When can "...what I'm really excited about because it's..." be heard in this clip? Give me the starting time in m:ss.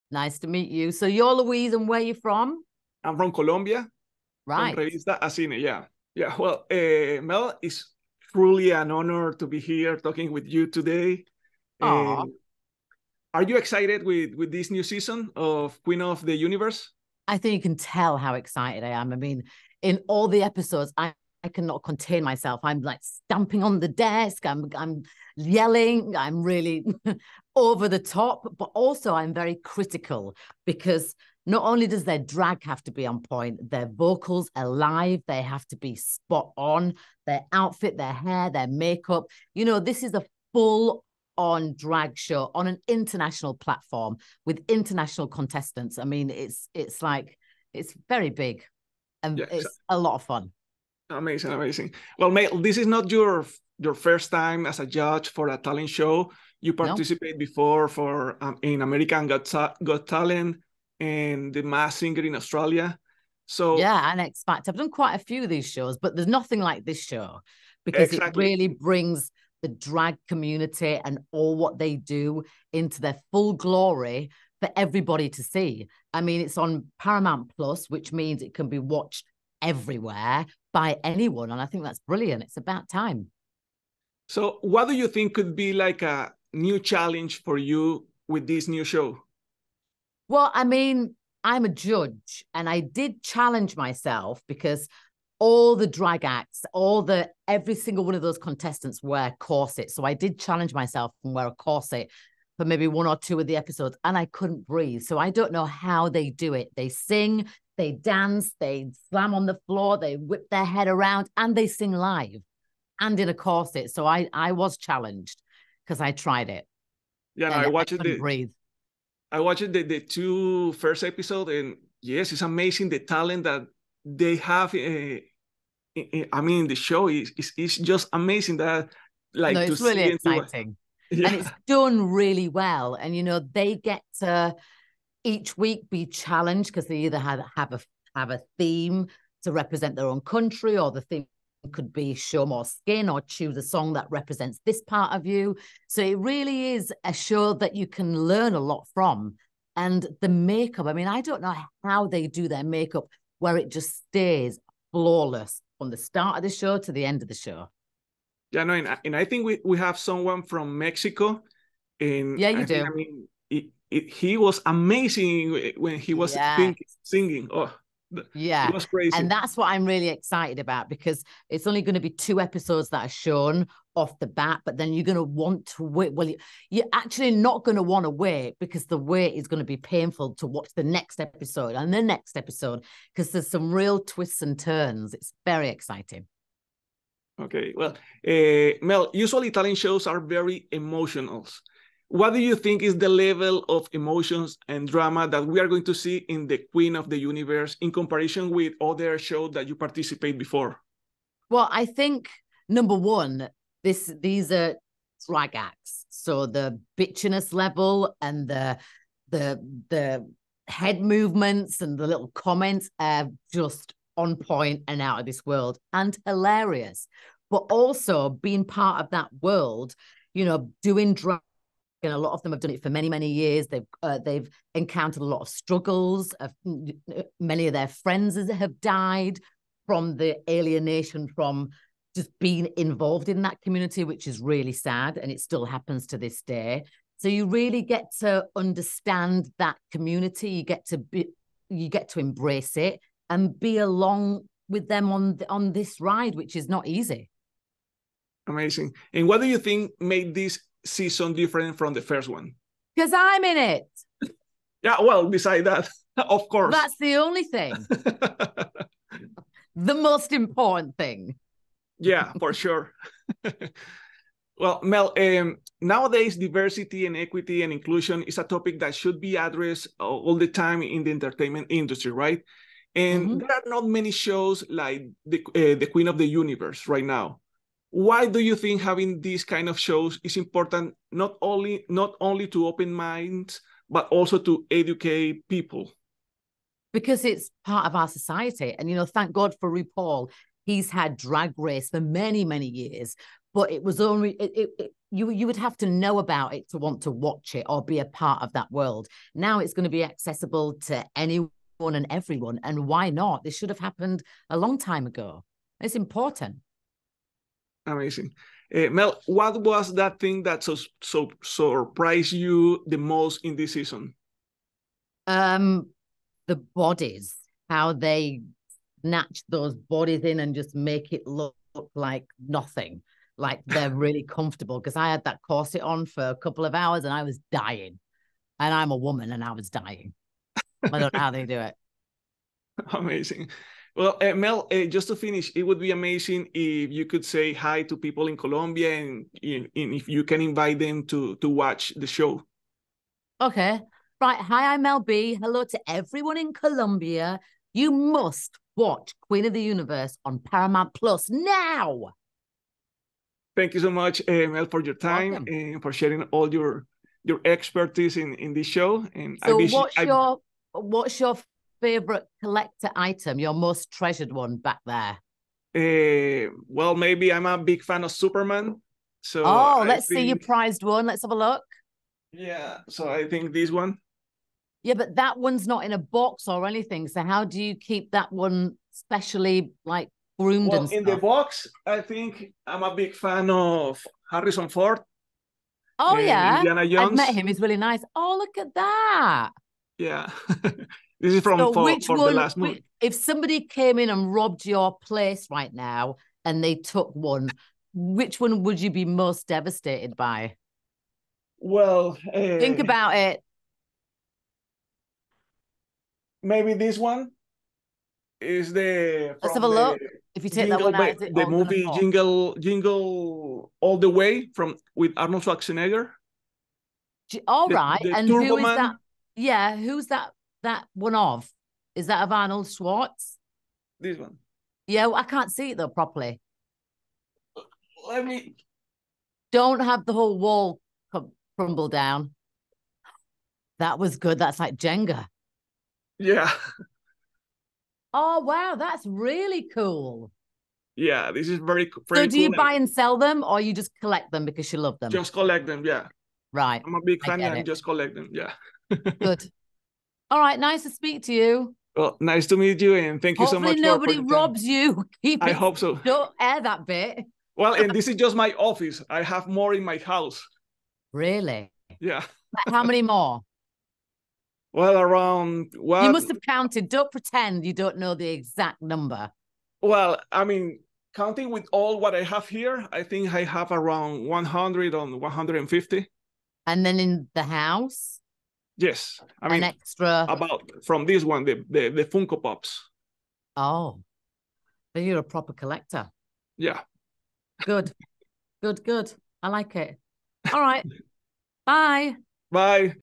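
2:49.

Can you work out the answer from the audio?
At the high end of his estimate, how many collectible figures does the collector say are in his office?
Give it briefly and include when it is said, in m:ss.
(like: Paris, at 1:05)
150, at 7:55.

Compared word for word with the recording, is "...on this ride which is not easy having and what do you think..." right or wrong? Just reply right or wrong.
wrong.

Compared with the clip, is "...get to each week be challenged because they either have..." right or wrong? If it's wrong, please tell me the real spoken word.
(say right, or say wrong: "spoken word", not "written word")
right.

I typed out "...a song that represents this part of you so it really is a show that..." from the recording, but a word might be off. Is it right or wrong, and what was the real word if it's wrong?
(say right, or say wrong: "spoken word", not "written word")
right.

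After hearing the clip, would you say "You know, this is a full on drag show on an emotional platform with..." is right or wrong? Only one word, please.
wrong.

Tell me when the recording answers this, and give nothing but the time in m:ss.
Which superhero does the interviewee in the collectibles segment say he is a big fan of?
6:08.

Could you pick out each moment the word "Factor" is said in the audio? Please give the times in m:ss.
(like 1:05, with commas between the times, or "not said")
1:04.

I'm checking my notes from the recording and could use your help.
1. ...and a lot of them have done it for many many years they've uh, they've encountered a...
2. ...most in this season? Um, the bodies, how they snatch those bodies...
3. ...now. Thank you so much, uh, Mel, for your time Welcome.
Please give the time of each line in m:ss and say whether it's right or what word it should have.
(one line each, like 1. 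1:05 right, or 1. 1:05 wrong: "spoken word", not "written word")
1. 3:42 right
2. 5:12 right
3. 5:51 right.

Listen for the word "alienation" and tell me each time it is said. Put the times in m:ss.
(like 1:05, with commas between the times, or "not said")
3:50.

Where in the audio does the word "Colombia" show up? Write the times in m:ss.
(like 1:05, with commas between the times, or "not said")
0:03, 5:38, 5:46.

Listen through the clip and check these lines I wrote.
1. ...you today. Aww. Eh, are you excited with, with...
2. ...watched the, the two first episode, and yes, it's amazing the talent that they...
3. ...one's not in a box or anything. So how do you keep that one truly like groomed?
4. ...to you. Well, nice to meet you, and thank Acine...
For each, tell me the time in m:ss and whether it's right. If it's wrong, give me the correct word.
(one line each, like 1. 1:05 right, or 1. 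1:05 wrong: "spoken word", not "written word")
1. 0:10 right
2. 1:59 right
3. 6:15 wrong: "specially", not "truly"
4. 7:31 wrong: "Hopefully", not "Acine".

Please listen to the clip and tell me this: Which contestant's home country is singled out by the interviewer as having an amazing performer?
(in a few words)
Mexico.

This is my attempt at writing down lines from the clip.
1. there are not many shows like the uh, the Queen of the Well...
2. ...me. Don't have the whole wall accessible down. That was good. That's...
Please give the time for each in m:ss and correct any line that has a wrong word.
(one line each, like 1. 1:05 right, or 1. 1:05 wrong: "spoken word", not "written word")
1. 4:33 wrong: "Universe", not "Well"
2. 7:08 wrong: "crumble", not "accessible".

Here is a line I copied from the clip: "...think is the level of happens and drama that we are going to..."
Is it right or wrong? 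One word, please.
wrong.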